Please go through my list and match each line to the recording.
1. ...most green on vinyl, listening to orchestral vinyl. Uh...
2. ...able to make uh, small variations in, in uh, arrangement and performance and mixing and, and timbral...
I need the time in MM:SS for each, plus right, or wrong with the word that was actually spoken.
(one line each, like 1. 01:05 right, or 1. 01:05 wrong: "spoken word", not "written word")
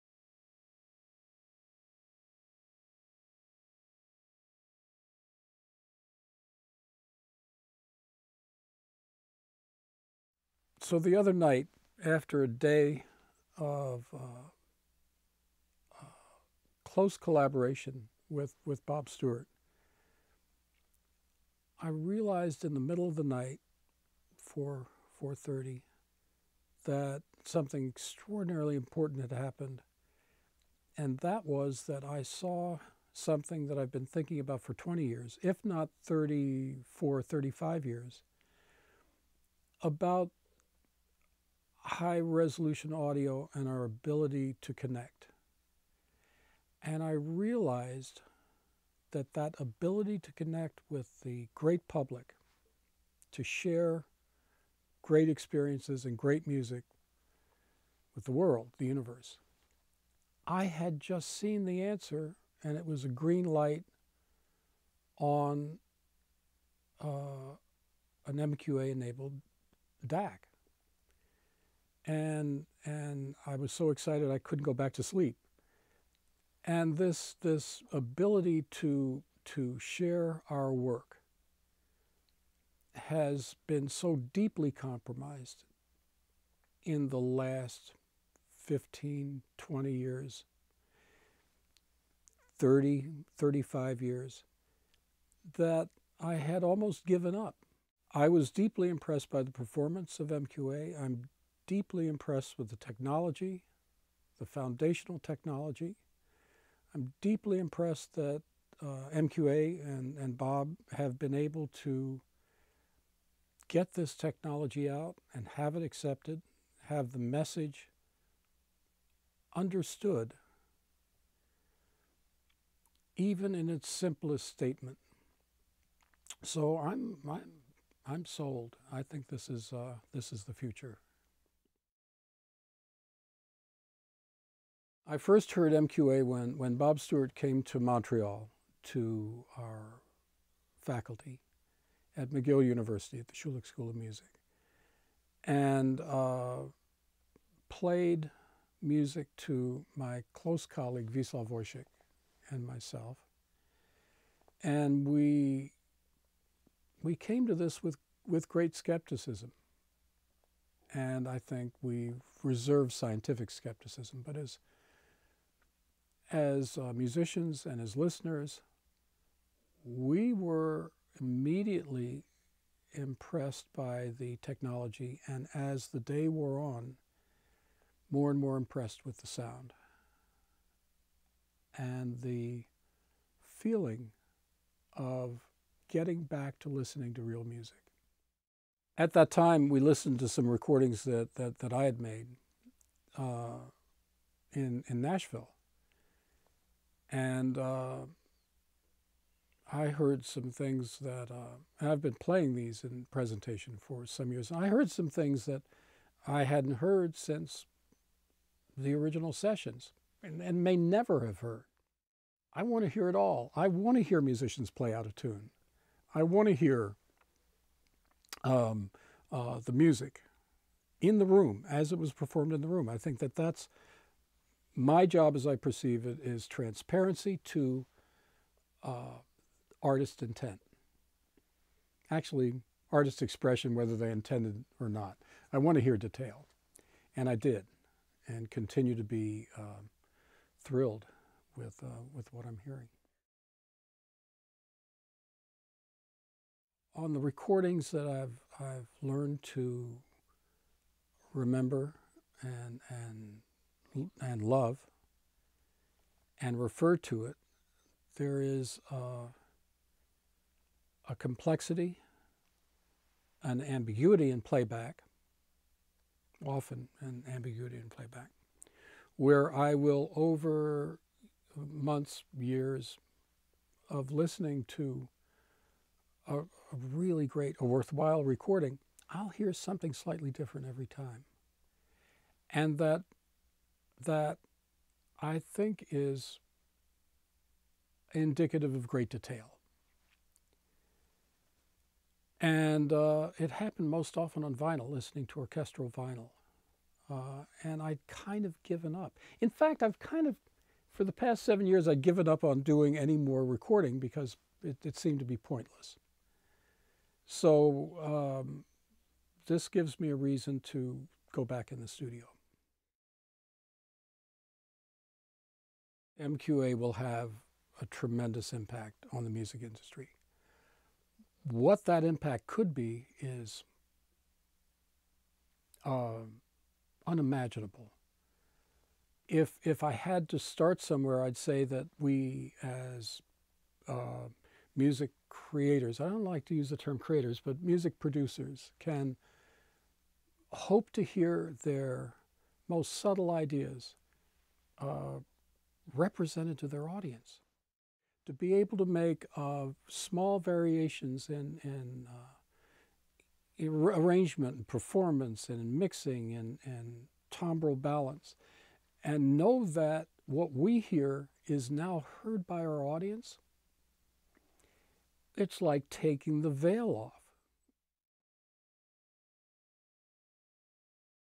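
1. 04:53 wrong: "often", not "green"
2. 05:48 right.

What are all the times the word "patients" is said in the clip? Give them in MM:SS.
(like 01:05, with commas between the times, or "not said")
not said.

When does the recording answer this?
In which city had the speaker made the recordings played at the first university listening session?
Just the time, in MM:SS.
03:14.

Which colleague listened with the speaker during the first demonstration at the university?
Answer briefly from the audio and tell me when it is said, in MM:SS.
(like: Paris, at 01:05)
Wieslaw Woszczyk, at 02:31.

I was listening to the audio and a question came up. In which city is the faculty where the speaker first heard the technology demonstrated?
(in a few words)
Montreal.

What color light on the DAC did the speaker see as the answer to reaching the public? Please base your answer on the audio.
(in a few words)
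Green.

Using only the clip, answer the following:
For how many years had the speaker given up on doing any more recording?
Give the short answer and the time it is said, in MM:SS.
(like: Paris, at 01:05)
7, at 05:01.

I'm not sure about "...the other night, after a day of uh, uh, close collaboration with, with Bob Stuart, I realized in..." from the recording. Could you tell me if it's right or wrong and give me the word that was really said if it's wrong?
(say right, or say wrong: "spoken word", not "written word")
right.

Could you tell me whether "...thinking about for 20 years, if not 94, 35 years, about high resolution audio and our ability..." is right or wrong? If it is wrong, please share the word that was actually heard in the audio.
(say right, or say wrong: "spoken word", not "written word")
wrong: "34", not "94".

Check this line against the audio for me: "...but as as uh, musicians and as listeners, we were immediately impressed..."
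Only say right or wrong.
right.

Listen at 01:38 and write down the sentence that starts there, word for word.
I was deeply impressed by the performance of MQA.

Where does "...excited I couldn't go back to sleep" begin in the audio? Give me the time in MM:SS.
01:13.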